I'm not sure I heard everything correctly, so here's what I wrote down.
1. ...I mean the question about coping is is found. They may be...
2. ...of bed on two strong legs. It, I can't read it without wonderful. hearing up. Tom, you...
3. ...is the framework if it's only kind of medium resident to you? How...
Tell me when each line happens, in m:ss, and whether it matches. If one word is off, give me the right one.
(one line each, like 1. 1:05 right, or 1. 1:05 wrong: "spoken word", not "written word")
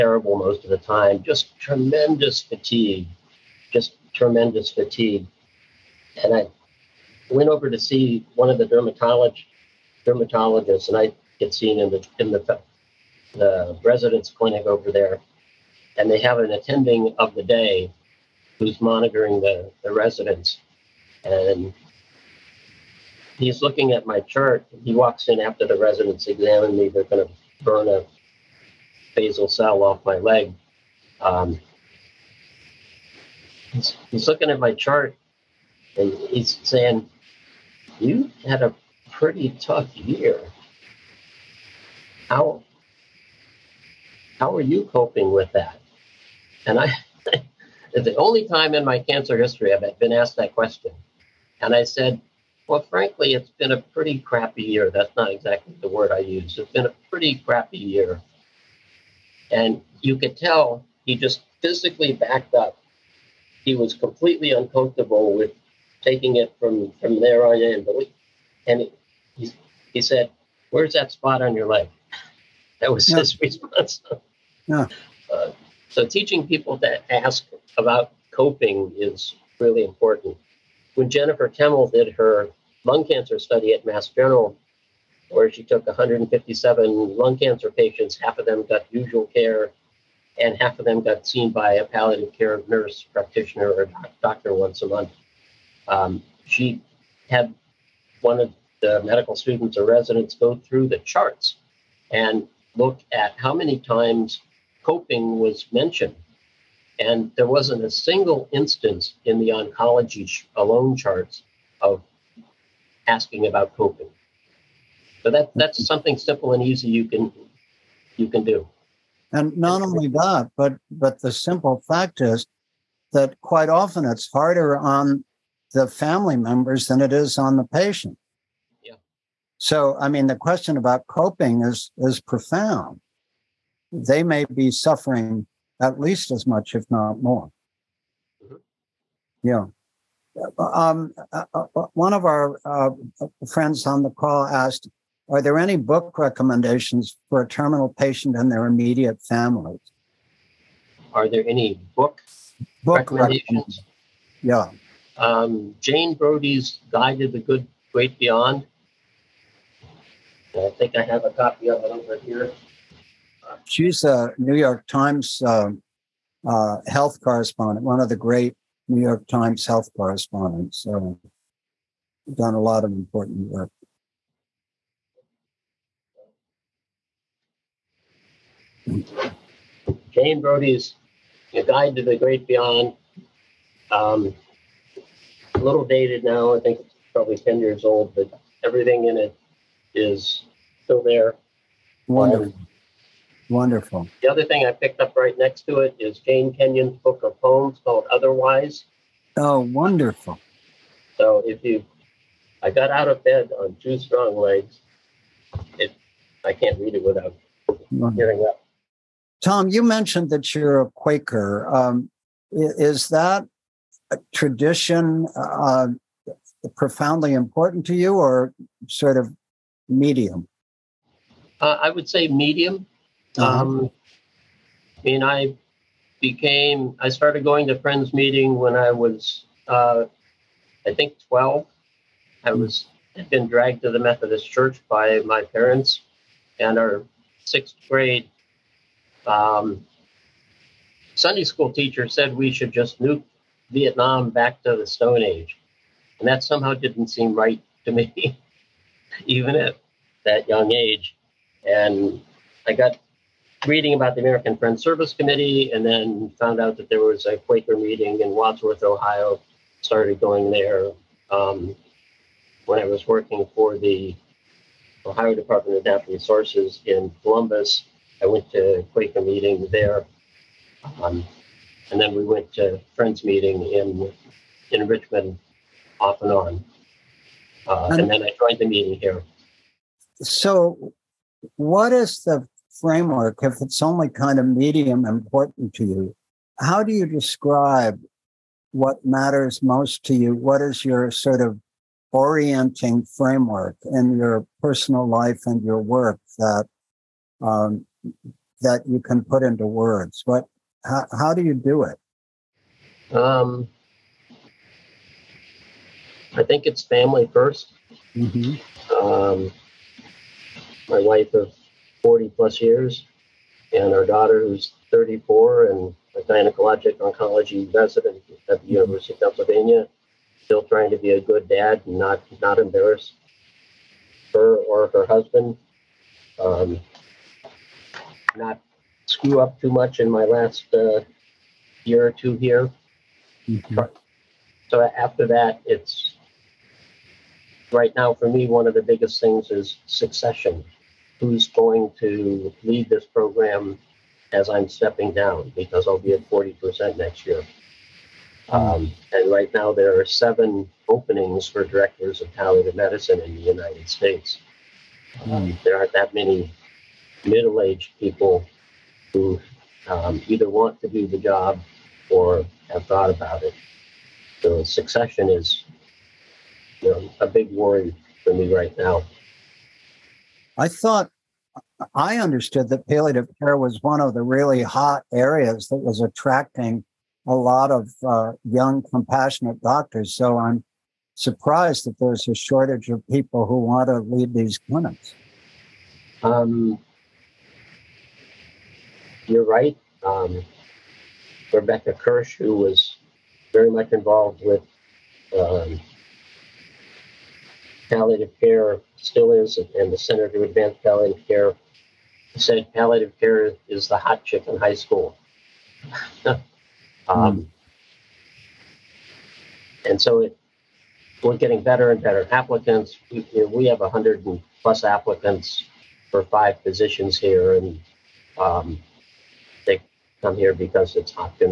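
1. 2:09 wrong: "profound", not "found"
2. 3:23 right
3. 4:41 wrong: "important", not "resident".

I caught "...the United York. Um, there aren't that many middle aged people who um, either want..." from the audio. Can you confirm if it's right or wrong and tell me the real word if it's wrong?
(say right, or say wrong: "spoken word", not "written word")
wrong: "States", not "York".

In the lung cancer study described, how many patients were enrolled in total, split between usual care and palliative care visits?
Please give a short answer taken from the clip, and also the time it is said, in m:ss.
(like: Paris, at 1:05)
157, at 1:25.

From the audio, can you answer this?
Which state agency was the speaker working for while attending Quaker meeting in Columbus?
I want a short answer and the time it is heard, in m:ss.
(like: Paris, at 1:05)
Ohio Department of Natural Resources, at 4:25.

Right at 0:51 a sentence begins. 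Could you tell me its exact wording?
And I said, well, frankly, it's been a pretty crappy year.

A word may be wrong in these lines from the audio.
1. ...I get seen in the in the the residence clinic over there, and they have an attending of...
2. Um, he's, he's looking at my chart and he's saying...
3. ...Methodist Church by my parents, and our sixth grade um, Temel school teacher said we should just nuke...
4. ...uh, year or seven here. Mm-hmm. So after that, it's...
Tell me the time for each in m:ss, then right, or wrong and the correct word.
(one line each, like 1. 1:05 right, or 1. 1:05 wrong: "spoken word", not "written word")
1. 0:10 right
2. 0:31 right
3. 3:53 wrong: "Sunday", not "Temel"
4. 5:30 wrong: "two", not "seven".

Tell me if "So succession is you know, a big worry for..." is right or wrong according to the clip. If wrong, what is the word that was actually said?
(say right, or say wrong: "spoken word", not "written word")
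right.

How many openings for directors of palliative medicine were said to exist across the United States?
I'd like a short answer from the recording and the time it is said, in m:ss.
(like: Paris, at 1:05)
7, at 5:50.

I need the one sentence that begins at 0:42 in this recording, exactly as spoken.
How, how are you coping with that?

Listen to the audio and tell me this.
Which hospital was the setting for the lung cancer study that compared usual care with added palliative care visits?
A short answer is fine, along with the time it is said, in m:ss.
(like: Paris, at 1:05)
Mass General, at 1:23.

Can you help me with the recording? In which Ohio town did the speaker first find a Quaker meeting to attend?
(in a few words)
Wadsworth.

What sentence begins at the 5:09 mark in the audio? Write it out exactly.
um, my wife of 40 plus years, and our daughter who's 34 and a gynecologic oncology resident at the mm-hmm.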